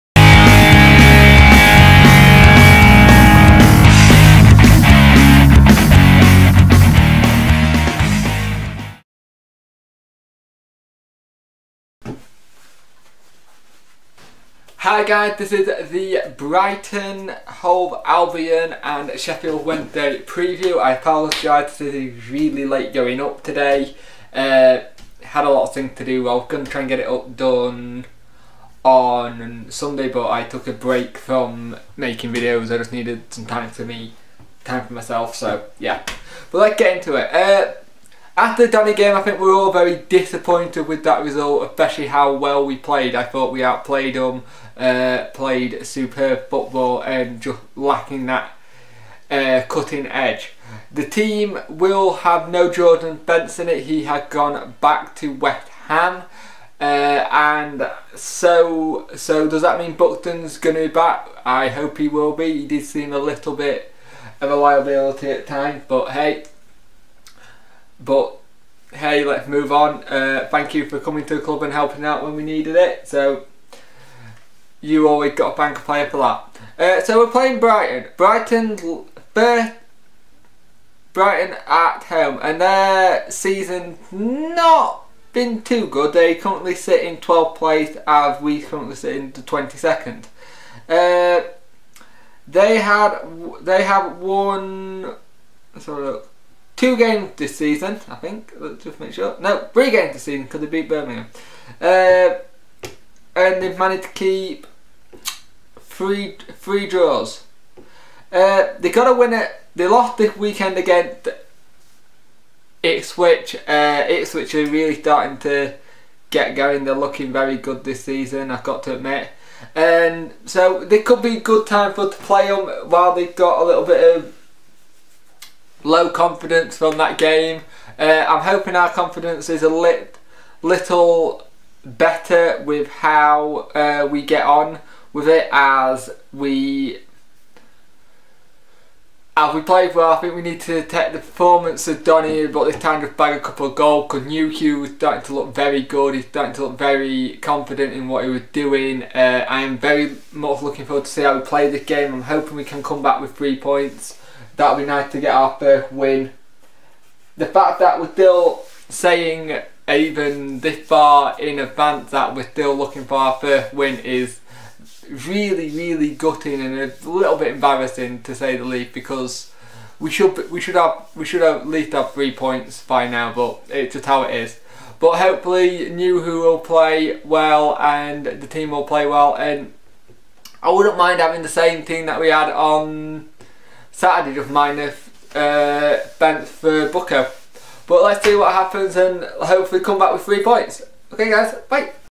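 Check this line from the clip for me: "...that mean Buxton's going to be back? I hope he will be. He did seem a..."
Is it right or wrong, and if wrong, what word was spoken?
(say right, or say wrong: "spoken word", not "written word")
right.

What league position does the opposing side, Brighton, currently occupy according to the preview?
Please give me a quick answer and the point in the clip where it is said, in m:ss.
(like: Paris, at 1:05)
12th, at 1:27.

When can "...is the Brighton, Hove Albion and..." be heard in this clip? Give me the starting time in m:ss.
0:15.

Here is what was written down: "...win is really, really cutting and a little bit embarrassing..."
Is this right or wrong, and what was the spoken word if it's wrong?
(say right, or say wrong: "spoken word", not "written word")
wrong: "gutting", not "cutting".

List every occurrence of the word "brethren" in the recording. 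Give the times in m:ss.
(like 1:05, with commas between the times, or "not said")
not said.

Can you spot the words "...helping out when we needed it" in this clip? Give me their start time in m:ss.
1:11.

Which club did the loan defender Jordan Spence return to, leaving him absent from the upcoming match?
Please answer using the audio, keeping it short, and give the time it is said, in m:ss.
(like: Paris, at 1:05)
West Ham, at 0:55.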